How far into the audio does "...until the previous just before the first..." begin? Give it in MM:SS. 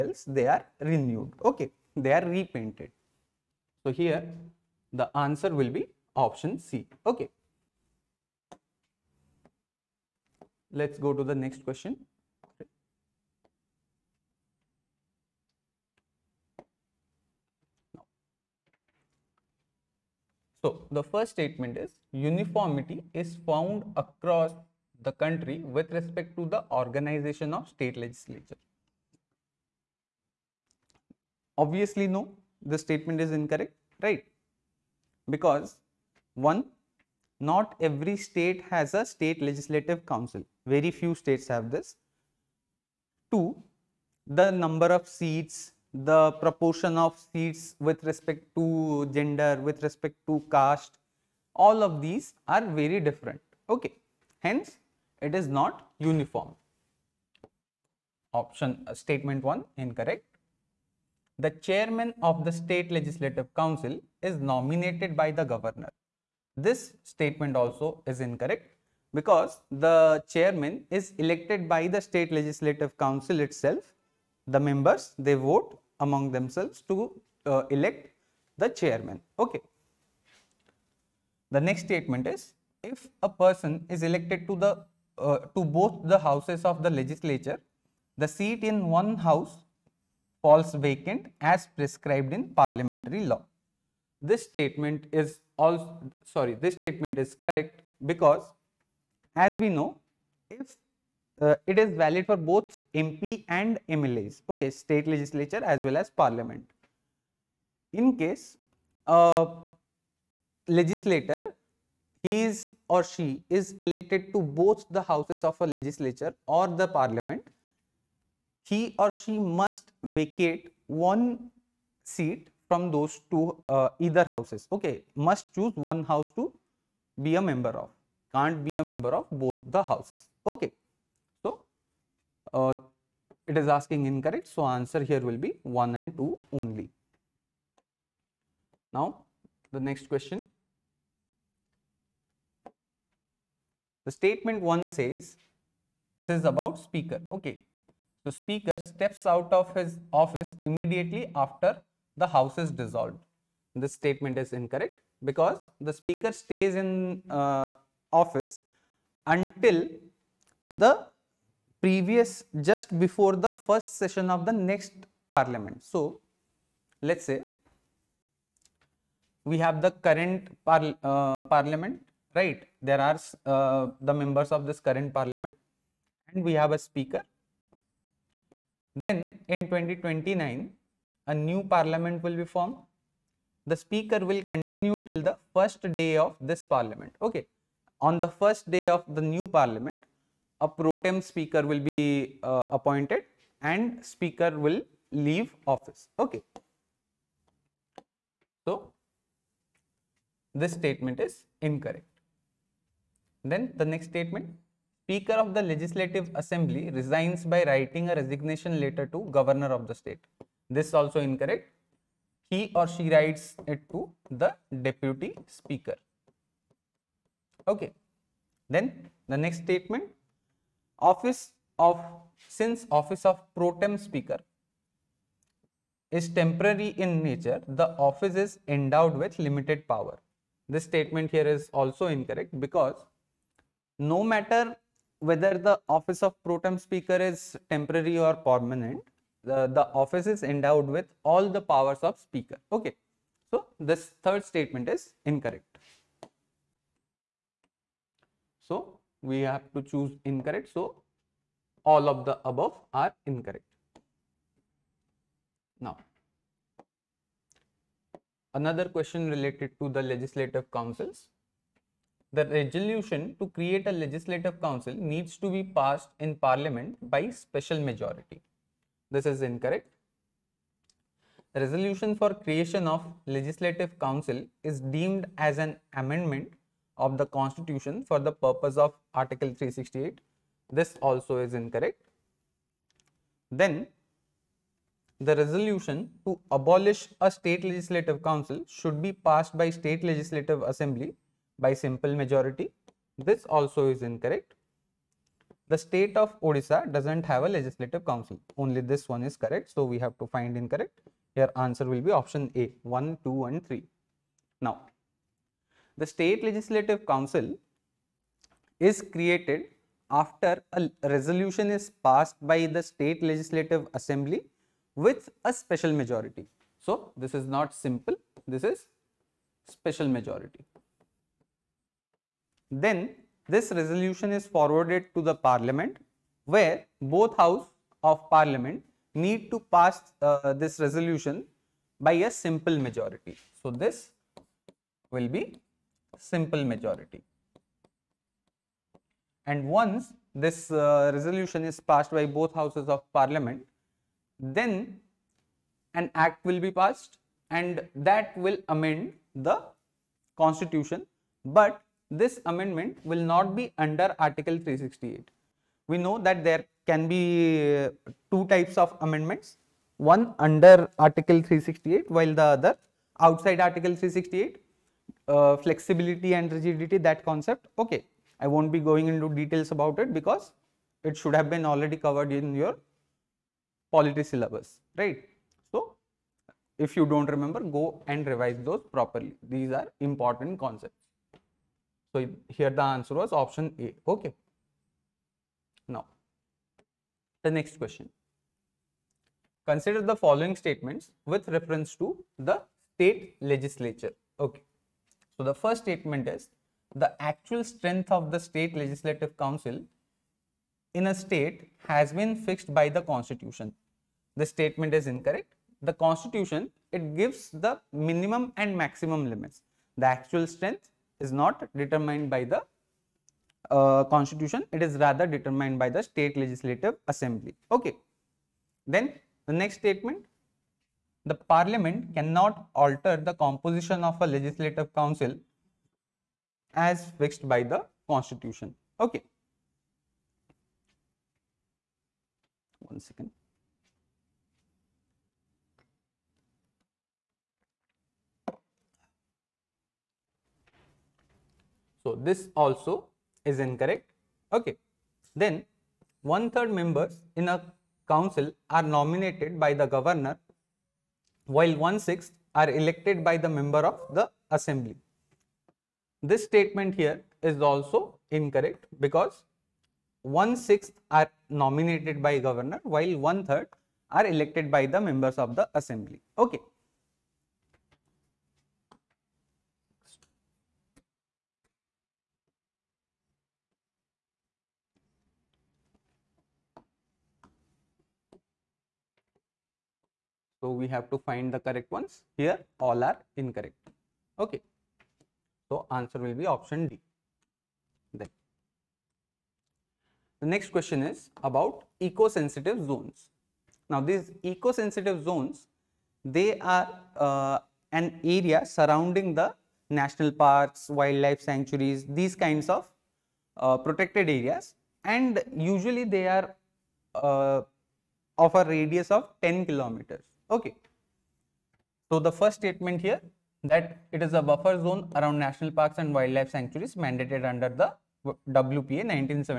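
02:39.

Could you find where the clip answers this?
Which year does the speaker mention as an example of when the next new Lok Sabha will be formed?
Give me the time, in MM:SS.
02:59.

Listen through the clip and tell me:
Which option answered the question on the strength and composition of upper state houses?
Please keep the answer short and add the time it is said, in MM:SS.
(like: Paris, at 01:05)
Option D, at 08:06.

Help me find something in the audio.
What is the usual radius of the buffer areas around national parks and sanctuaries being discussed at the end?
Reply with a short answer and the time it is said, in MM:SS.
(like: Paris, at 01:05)
10 kilometers, at 08:29.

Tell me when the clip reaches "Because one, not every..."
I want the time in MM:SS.
00:35.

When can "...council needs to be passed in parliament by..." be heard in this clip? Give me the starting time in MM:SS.
04:24.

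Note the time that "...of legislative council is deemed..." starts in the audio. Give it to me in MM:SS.
04:32.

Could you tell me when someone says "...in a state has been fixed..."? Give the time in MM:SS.
06:40.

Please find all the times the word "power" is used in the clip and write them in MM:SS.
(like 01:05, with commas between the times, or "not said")
03:49, 04:01.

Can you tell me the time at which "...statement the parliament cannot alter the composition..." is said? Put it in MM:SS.
06:59.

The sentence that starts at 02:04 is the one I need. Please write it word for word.
Okay, must choose one house to be a member of, can't be a member of both the houses.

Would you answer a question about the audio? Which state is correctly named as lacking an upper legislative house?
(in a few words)
Odisha.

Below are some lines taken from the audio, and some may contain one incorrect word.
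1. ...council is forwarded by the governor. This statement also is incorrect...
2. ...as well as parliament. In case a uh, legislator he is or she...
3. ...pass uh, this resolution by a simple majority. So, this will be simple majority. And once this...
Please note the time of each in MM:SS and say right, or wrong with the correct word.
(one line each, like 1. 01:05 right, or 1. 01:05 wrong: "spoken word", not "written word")
1. 01:03 wrong: "nominated", not "forwarded"
2. 01:45 right
3. 05:29 right.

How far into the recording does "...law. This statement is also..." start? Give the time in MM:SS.
01:33.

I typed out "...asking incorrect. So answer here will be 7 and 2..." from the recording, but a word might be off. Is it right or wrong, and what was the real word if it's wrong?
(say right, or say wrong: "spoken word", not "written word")
wrong: "1", not "7".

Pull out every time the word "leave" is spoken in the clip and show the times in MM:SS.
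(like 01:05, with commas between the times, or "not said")
03:15.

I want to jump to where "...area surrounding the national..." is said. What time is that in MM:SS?
08:18.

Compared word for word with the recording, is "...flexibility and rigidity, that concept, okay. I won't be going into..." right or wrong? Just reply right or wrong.
right.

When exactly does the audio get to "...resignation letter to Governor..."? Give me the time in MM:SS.
03:28.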